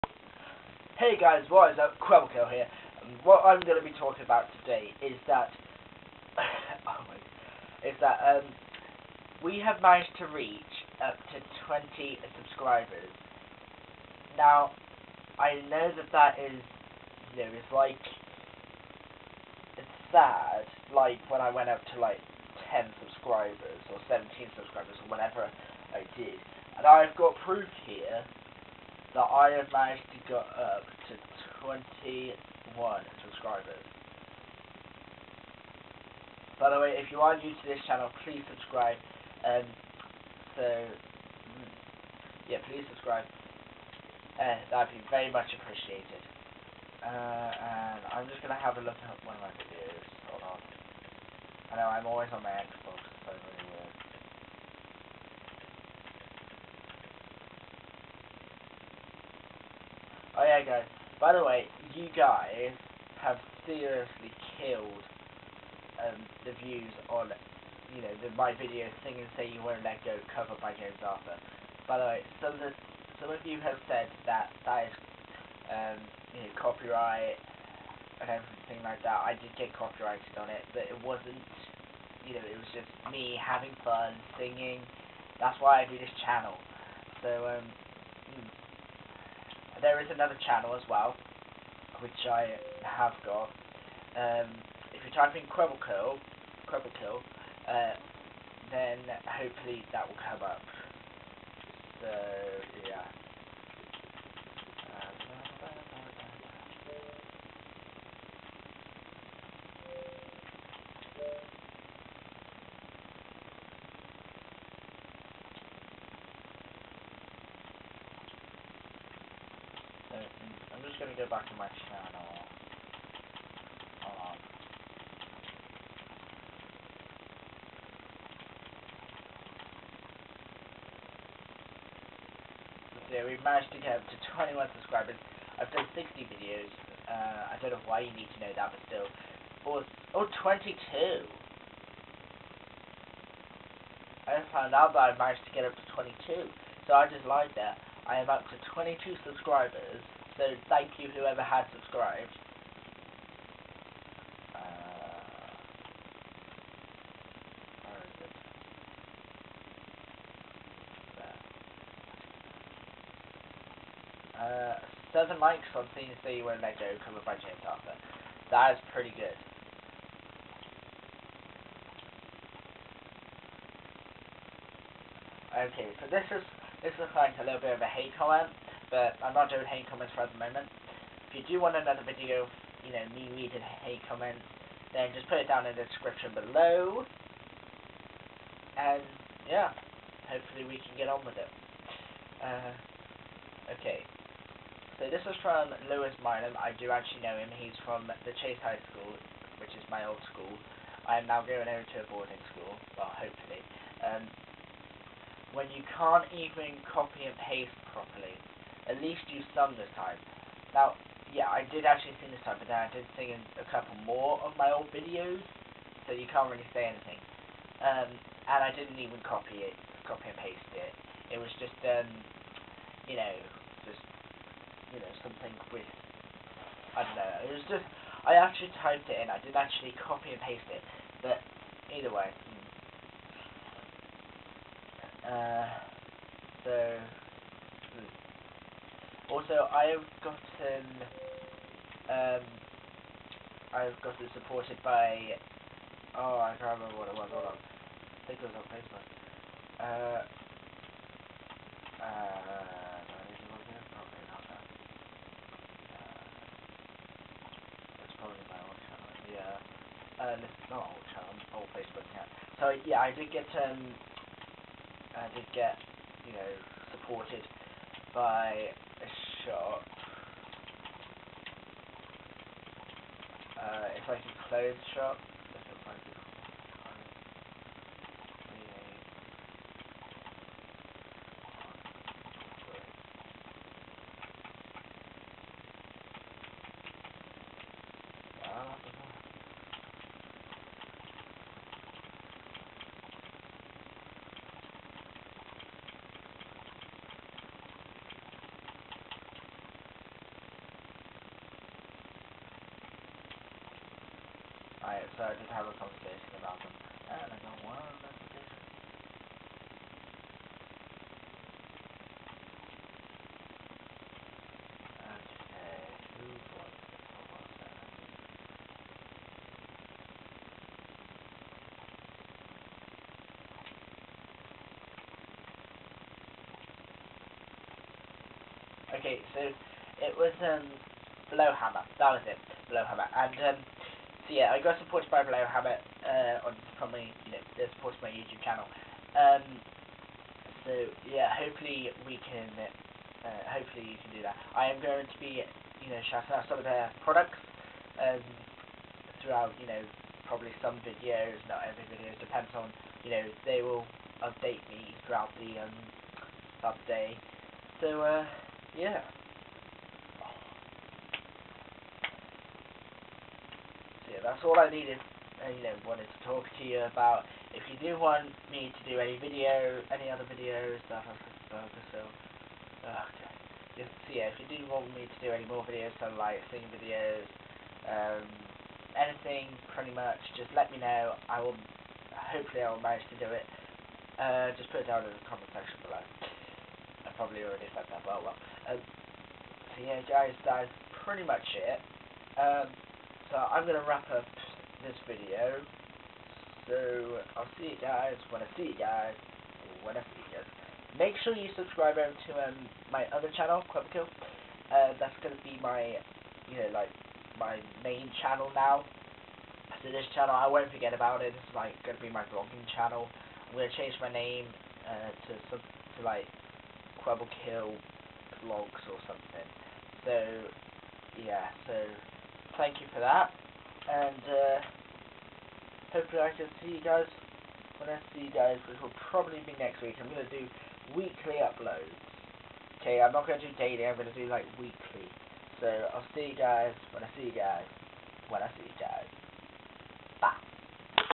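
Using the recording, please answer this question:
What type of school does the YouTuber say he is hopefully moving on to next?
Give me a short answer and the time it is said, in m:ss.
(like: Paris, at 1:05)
Boarding school, at 3:22.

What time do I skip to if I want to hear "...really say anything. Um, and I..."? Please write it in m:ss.
3:36.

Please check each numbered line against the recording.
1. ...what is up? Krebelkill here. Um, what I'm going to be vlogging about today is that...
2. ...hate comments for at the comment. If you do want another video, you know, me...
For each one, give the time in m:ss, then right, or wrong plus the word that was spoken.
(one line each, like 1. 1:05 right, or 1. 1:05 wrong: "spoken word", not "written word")
1. 0:01 wrong: "talking", not "vlogging"
2. 2:59 wrong: "moment", not "comment".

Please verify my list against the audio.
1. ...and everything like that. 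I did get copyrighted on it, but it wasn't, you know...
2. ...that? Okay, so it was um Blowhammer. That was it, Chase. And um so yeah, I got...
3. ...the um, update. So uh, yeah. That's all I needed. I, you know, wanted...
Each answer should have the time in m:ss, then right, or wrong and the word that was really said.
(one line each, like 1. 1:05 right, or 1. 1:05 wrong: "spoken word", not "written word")
1. 1:18 right
2. 5:28 wrong: "Blowhammer", not "Chase"
3. 5:55 right.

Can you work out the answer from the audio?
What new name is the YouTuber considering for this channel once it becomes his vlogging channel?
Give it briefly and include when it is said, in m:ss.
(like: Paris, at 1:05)
Quibble Kill Vlogs, at 6:56.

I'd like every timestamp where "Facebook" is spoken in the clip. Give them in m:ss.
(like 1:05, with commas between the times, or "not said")
4:08, 4:21.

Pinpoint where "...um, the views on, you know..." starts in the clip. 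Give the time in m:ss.
1:06.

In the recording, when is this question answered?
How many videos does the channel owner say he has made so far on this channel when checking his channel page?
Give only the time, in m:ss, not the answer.
2:15.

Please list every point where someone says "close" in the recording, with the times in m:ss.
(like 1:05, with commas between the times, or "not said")
4:34.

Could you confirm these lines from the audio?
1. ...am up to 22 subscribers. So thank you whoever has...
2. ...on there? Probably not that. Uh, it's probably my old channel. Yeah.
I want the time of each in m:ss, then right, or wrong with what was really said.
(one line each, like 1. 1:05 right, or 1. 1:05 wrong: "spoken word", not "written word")
1. 2:28 right
2. 4:13 right.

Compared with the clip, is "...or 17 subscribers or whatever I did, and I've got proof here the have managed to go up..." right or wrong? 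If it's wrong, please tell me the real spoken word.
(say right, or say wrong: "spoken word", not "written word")
right.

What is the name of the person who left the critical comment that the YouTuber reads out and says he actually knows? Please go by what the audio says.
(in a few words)
Lewis Milam.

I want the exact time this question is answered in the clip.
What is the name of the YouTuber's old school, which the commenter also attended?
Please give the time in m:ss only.
3:18.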